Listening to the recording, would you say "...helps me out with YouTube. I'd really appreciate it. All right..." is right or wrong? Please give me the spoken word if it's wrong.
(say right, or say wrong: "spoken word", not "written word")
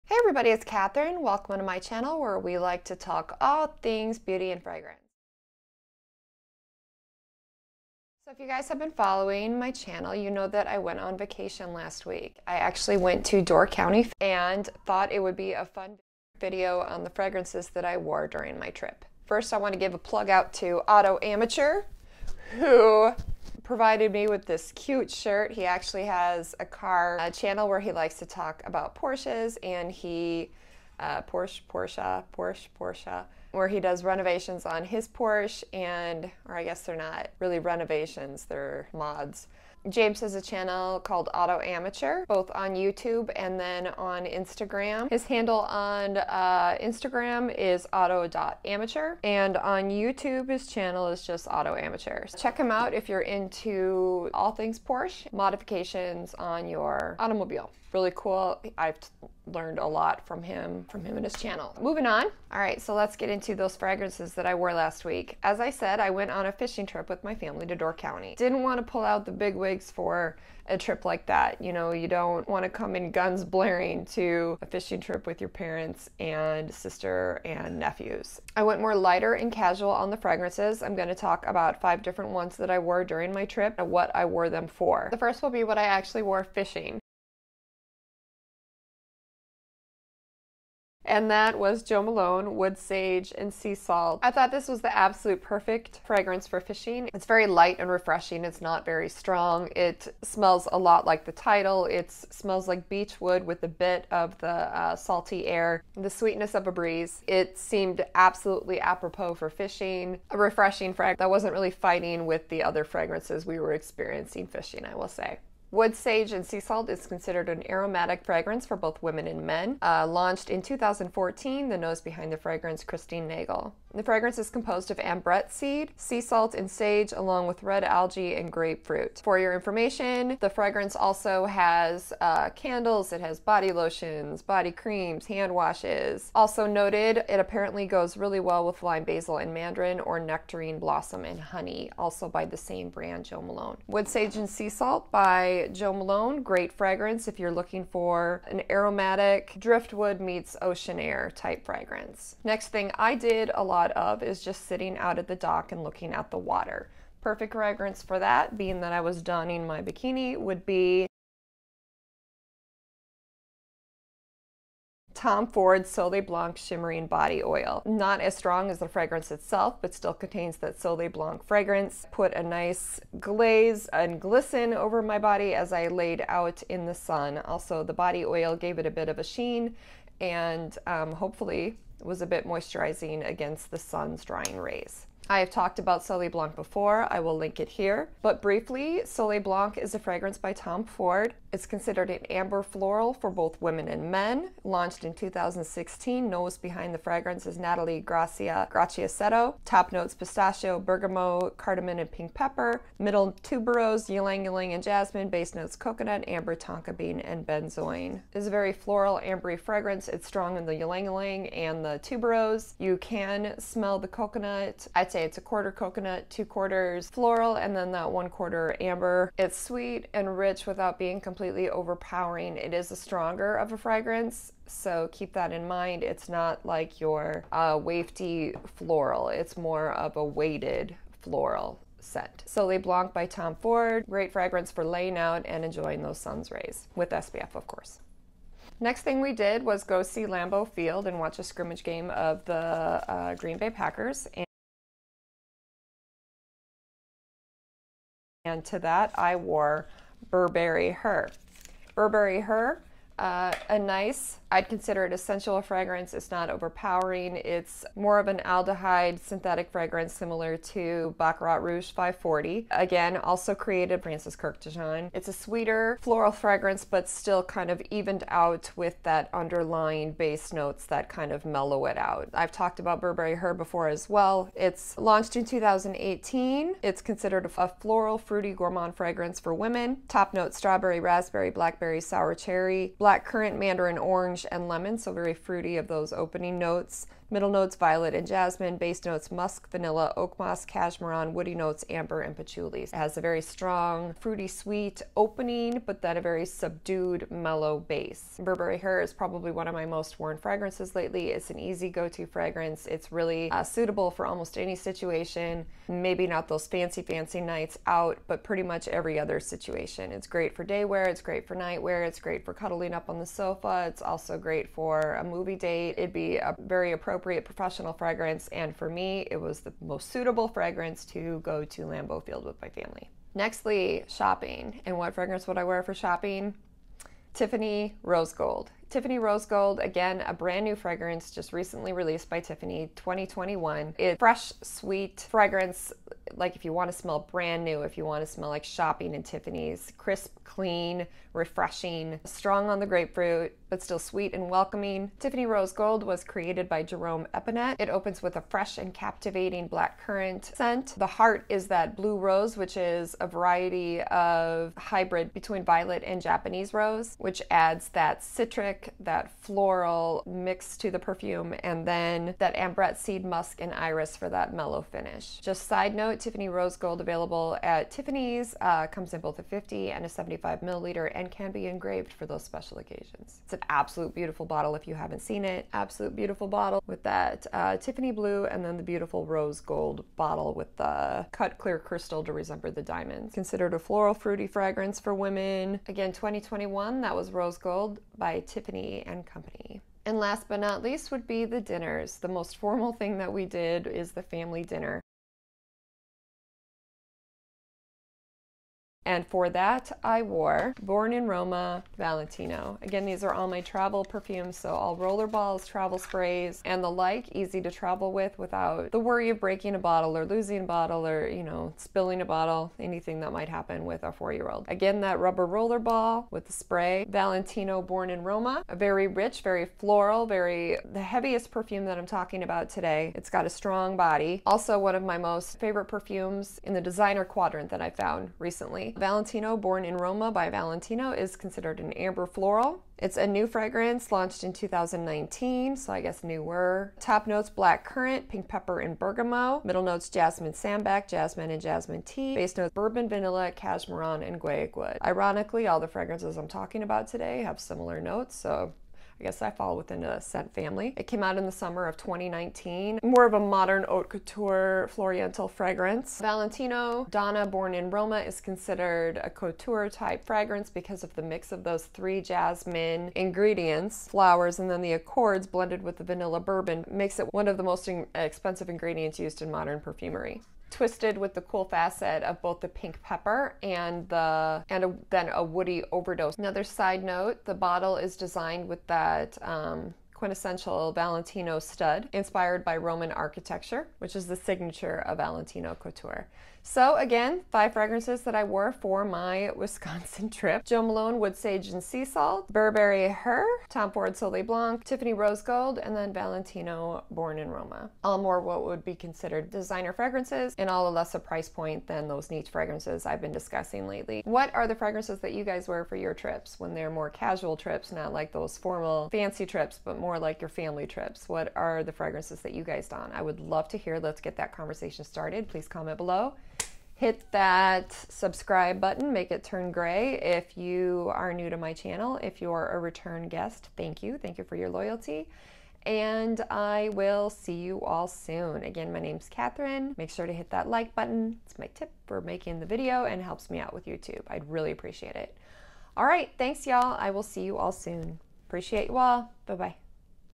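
right.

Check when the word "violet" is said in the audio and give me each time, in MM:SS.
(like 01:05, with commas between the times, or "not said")
04:47, 05:55.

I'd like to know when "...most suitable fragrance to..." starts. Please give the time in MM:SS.
05:19.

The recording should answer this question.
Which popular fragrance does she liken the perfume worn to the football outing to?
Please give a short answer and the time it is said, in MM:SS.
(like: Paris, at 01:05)
Baccarat Rouge 540, at 04:21.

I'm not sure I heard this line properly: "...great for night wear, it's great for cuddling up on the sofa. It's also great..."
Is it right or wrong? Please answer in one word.
right.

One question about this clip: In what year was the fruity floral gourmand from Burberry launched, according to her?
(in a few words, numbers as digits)
2018.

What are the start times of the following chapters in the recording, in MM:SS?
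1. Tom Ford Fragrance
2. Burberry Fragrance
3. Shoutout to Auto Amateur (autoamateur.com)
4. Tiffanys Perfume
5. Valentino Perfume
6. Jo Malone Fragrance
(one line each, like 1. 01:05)
1. 02:30
2. 04:11
3. 00:20
4. 05:20
5. 06:30
6. 01:30.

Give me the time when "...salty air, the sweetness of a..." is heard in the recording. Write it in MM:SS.
01:44.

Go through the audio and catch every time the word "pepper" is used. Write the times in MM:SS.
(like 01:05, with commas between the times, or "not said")
03:22, 07:18, 07:53.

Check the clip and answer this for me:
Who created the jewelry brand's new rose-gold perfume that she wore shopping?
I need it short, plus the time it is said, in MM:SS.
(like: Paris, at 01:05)
Jerome Epinette, at 05:46.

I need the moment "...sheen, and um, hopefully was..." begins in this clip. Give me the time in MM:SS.
02:59.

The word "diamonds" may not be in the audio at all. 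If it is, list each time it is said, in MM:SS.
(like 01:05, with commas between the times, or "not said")
06:22.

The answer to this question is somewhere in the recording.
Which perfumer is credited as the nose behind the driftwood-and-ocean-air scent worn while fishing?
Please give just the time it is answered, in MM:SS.
02:02.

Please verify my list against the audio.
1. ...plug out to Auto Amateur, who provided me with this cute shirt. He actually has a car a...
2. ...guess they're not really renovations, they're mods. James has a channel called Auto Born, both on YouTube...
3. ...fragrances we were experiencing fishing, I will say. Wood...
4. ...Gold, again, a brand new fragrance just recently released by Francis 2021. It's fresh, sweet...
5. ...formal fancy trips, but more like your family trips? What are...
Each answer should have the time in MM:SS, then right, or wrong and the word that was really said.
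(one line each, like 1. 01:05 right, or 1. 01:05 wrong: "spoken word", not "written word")
1. 00:19 right
2. 00:36 wrong: "Amateur", not "Born"
3. 01:52 right
4. 05:29 wrong: "Tiffany", not "Francis"
5. 08:28 right.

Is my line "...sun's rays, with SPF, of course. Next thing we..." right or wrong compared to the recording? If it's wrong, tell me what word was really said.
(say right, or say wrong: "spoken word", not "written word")
right.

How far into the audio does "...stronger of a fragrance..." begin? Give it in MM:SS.
03:42.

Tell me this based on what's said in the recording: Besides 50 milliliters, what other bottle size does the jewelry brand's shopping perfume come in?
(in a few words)
75 milliliters.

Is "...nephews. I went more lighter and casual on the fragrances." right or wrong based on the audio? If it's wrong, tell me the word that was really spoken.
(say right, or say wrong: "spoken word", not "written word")
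right.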